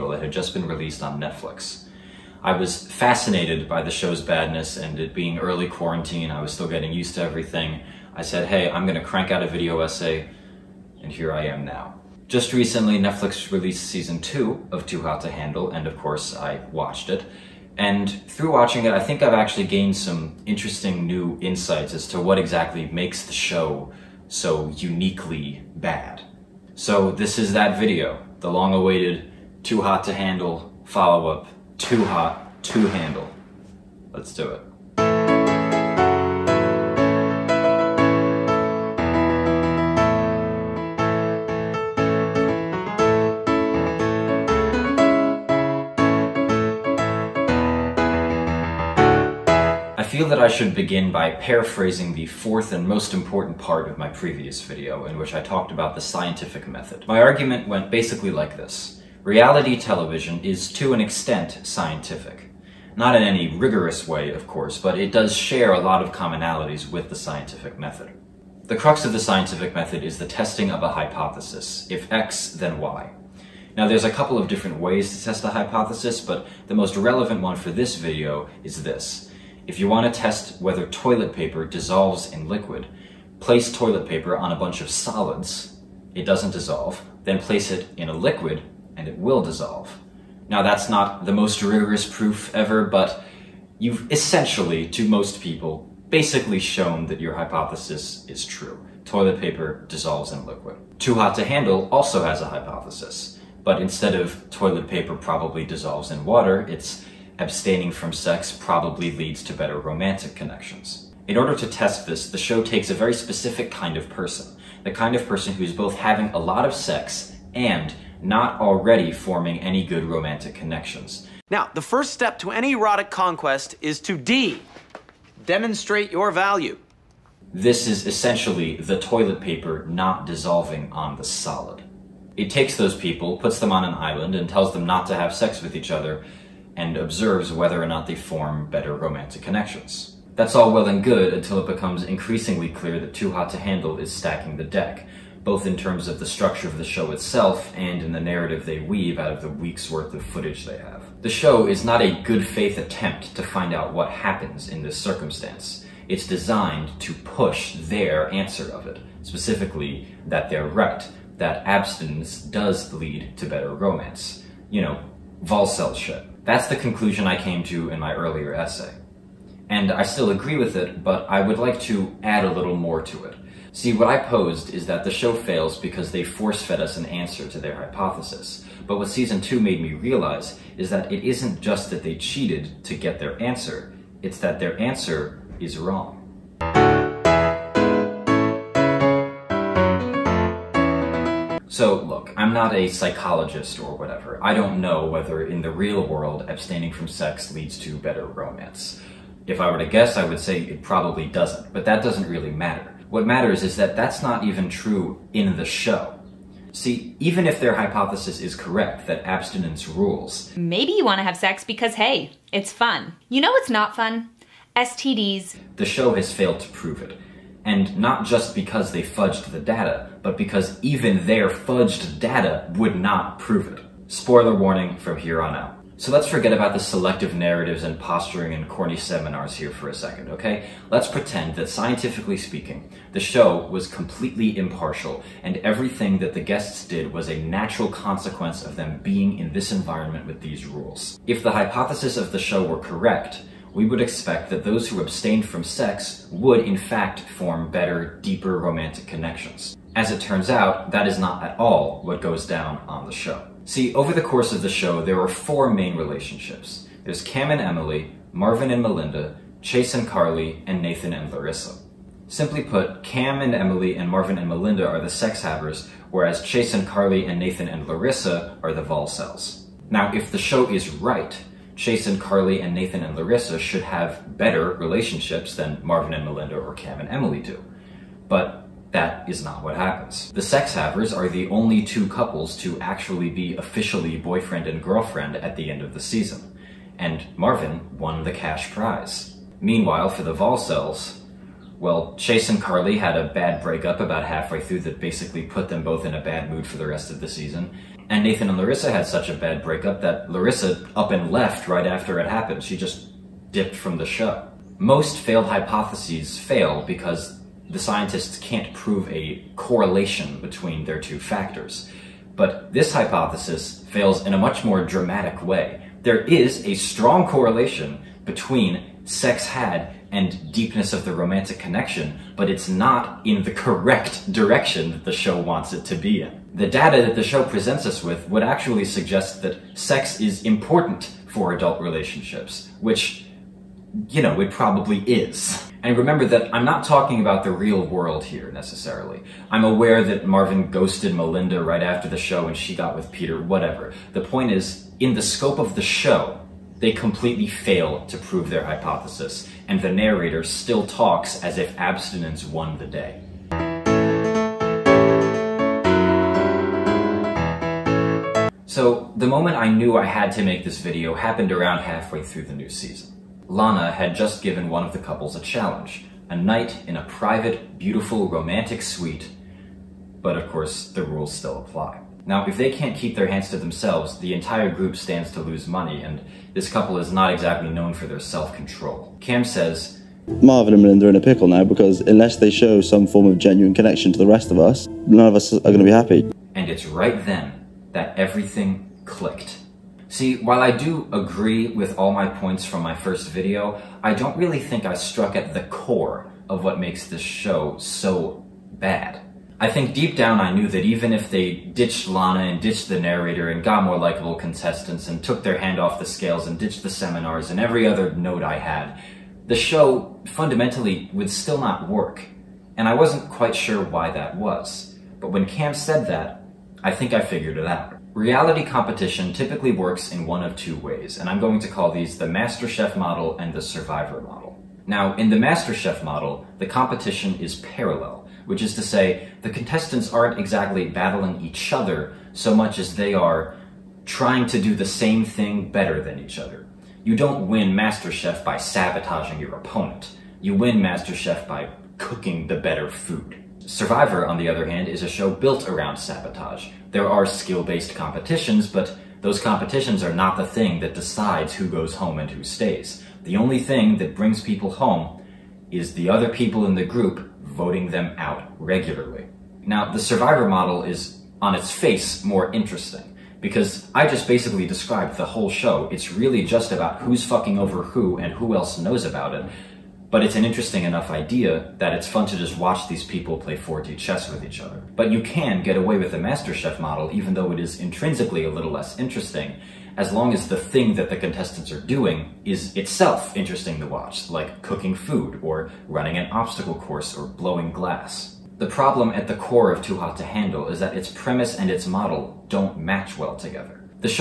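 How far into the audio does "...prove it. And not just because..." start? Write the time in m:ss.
3:36.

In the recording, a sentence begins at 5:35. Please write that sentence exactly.
And remember that I'm not talking about the real world here, necessarily.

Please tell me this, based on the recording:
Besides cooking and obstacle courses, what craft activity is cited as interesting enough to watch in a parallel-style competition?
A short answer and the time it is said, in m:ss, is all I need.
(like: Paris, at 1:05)
Blowing glass, at 8:07.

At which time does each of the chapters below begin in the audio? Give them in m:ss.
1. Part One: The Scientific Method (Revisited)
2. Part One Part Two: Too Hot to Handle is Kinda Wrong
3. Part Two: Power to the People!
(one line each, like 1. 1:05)
1. 0:44
2. 3:06
3. 5:53.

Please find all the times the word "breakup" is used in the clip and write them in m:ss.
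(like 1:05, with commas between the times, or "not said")
4:53, 4:59.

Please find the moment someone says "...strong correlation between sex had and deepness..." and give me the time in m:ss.
5:16.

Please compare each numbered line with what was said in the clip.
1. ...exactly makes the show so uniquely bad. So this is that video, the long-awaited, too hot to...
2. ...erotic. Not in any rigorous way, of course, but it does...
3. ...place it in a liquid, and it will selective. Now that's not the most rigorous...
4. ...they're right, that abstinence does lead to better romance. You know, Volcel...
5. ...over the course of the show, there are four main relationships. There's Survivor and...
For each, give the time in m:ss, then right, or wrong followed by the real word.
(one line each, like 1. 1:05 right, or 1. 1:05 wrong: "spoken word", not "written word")
1. 0:22 right
2. 1:01 wrong: "scientific", not "erotic"
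3. 1:27 wrong: "dissolve", not "selective"
4. 2:40 right
5. 4:13 wrong: "Cam", not "Survivor".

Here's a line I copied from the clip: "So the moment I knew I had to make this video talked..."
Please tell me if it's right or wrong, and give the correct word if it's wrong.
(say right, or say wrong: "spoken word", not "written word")
wrong: "happened", not "talked".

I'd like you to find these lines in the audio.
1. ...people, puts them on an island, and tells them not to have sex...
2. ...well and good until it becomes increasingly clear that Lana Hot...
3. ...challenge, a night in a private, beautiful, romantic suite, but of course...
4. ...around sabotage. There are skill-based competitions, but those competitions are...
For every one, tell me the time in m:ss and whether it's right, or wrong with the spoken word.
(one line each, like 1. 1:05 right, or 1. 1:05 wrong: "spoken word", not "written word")
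1. 2:12 right
2. 2:20 wrong: "Too", not "Lana"
3. 6:05 right
4. 7:25 right.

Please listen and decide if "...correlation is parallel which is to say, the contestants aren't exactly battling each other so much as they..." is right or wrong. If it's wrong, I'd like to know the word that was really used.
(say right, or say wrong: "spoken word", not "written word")
wrong: "competition", not "correlation".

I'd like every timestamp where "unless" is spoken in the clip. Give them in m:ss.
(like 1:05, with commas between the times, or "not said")
6:22.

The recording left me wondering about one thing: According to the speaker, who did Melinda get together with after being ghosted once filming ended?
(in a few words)
Peter.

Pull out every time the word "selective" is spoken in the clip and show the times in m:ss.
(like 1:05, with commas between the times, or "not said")
3:46.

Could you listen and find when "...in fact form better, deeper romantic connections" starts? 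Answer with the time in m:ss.
4:06.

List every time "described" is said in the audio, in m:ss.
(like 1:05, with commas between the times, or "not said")
7:44.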